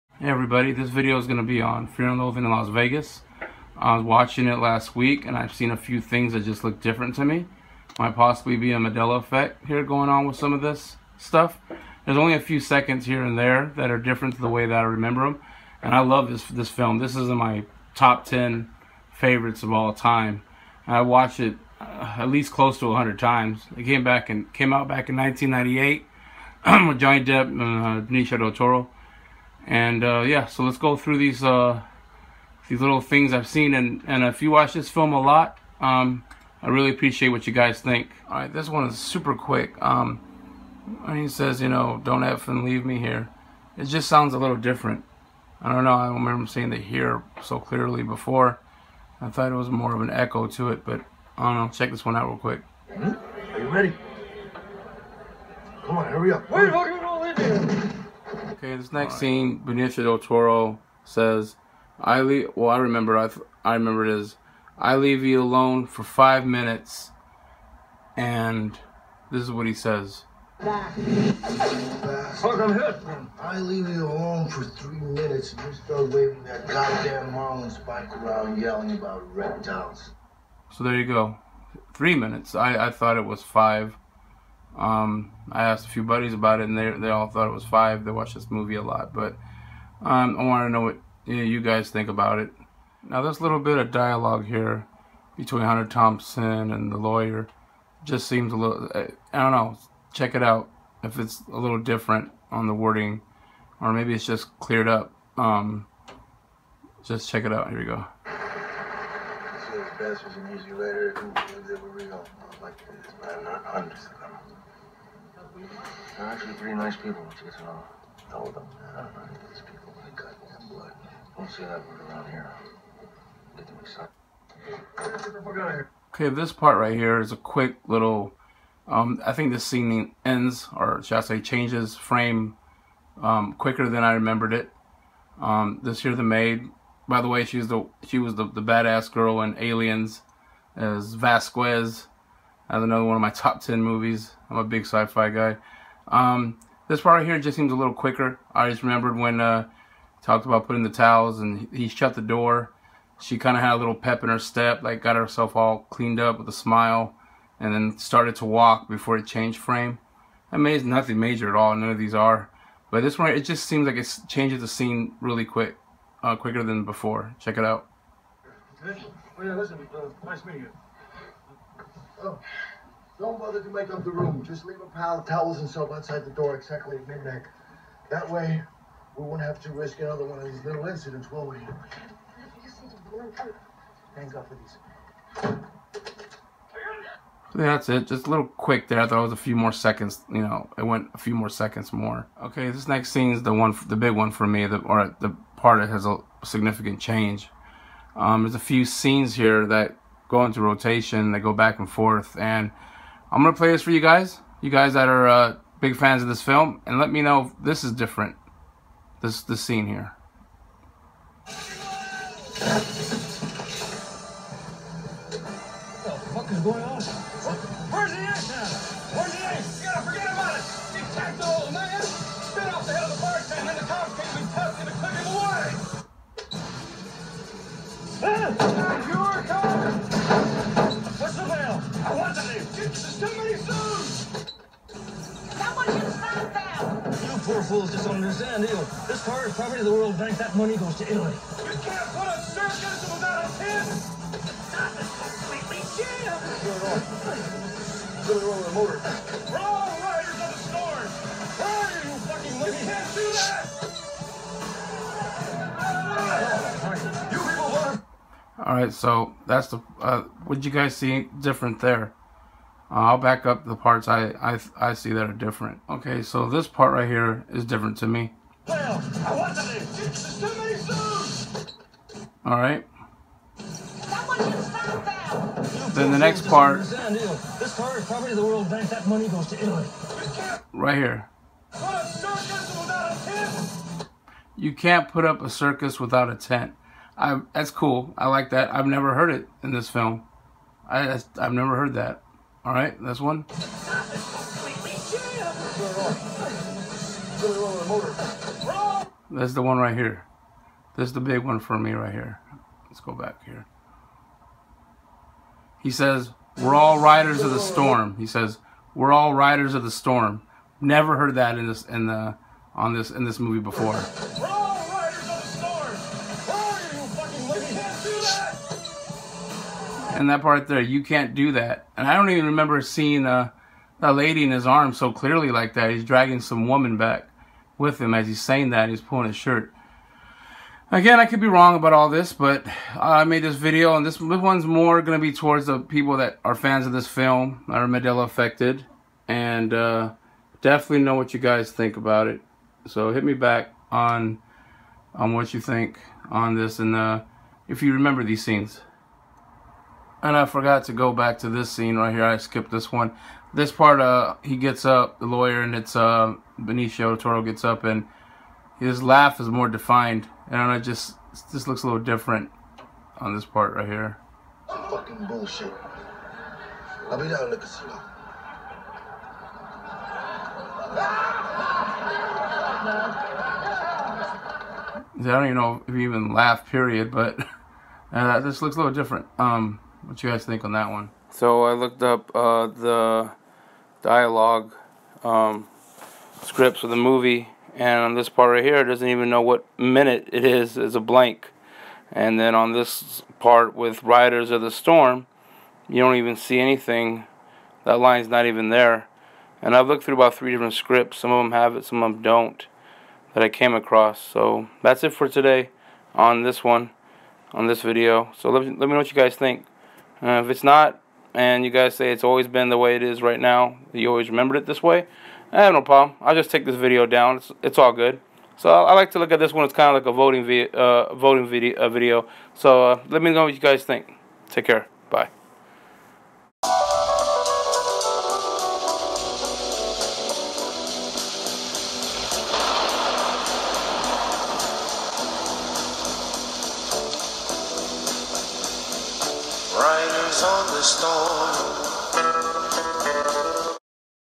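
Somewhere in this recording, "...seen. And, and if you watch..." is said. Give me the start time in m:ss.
0:33.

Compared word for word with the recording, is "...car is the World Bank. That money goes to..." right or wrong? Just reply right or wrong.
right.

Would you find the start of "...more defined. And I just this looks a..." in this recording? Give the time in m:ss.
5:59.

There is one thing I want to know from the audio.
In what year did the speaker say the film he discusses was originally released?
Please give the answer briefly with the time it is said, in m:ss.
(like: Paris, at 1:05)
1998, at 0:25.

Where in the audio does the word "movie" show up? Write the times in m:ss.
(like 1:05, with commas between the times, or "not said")
1:28, 2:23, 5:13, 6:26.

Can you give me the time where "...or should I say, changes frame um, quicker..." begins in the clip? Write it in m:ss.
2:10.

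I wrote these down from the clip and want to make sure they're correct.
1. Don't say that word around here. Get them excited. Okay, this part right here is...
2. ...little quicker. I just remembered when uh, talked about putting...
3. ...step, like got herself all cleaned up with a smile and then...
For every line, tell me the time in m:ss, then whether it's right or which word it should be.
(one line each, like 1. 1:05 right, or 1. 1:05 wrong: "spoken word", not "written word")
1. 2:01 right
2. 2:27 right
3. 2:34 right.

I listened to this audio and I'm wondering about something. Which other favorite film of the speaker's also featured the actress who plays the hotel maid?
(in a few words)
Aliens.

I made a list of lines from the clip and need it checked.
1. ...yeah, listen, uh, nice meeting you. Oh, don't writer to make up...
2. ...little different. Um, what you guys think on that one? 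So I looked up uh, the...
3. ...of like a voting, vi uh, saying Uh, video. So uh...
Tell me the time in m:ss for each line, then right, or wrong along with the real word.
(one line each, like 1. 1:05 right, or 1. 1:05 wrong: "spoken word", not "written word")
1. 2:49 wrong: "bother", not "writer"
2. 6:18 right
3. 6:59 wrong: "voting", not "saying".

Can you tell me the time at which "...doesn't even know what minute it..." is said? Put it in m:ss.
6:28.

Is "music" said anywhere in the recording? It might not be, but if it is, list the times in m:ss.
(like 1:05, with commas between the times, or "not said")
1:50.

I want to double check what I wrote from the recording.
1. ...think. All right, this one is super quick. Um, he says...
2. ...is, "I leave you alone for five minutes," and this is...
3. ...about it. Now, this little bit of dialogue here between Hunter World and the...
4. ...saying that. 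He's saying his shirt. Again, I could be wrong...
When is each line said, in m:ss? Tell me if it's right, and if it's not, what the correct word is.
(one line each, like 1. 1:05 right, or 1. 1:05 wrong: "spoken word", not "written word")
1. 0:37 right
2. 1:04 right
3. 1:32 wrong: "Thompson", not "World"
4. 5:28 wrong: "pulling", not "saying".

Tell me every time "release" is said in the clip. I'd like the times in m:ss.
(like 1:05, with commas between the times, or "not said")
not said.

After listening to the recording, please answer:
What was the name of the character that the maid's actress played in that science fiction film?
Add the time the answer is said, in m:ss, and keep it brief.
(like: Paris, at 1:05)
Vasquez, at 2:21.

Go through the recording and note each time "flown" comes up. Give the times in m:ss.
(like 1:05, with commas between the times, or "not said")
not said.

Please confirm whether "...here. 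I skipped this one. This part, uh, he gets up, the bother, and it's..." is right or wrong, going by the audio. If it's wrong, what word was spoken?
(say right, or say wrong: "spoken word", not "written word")
wrong: "lawyer", not "bother".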